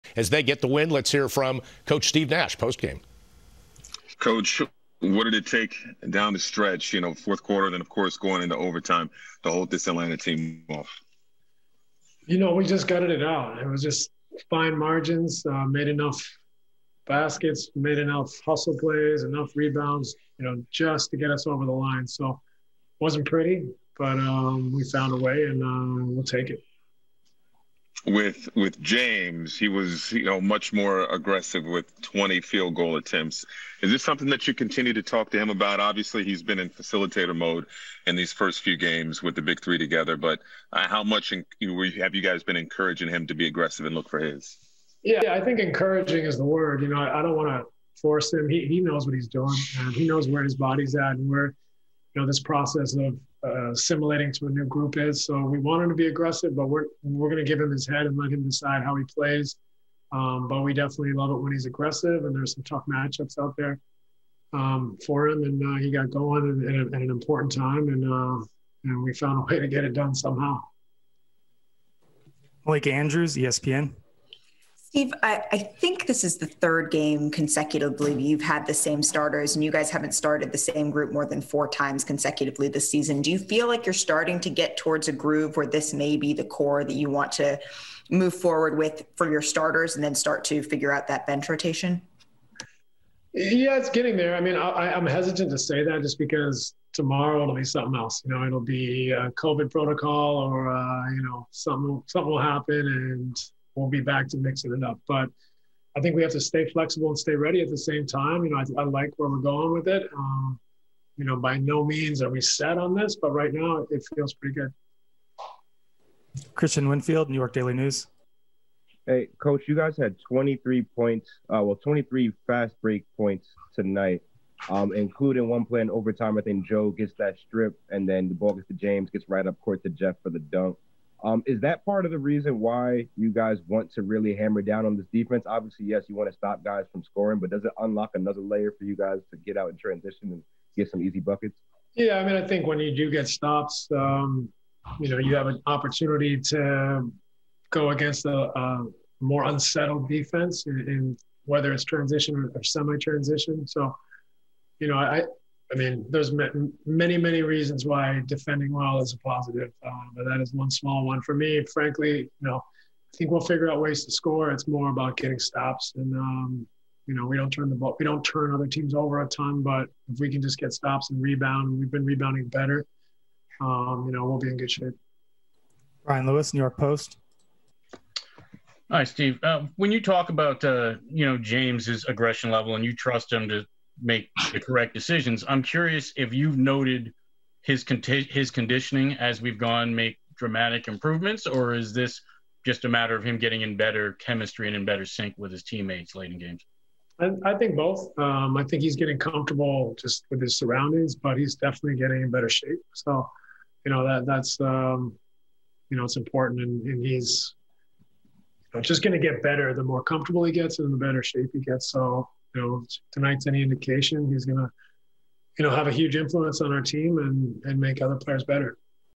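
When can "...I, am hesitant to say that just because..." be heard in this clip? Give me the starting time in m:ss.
1:34.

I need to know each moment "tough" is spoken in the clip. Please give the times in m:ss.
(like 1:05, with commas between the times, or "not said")
1:02.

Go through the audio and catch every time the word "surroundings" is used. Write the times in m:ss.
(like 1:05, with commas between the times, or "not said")
3:20.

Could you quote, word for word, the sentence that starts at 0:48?
He he knows what he's doing.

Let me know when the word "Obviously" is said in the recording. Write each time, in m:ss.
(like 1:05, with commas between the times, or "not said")
0:35, 2:15.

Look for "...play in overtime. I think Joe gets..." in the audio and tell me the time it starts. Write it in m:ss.
2:05.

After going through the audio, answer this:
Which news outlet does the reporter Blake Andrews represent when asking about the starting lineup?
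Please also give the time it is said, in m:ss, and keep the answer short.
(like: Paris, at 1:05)
ESPN, at 1:13.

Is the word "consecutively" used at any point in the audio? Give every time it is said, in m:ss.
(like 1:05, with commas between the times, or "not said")
1:17, 1:22.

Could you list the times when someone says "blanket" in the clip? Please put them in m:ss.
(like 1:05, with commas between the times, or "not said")
not said.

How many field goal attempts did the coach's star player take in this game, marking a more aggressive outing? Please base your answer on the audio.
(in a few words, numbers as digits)
20.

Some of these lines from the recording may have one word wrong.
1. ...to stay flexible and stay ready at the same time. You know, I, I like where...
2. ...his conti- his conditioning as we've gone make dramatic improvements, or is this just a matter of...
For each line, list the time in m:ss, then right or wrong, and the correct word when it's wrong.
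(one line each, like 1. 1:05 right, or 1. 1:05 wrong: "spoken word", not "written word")
1. 1:46 right
2. 3:07 right.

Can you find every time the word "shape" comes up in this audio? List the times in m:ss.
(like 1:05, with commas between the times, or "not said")
2:54, 3:22, 3:31.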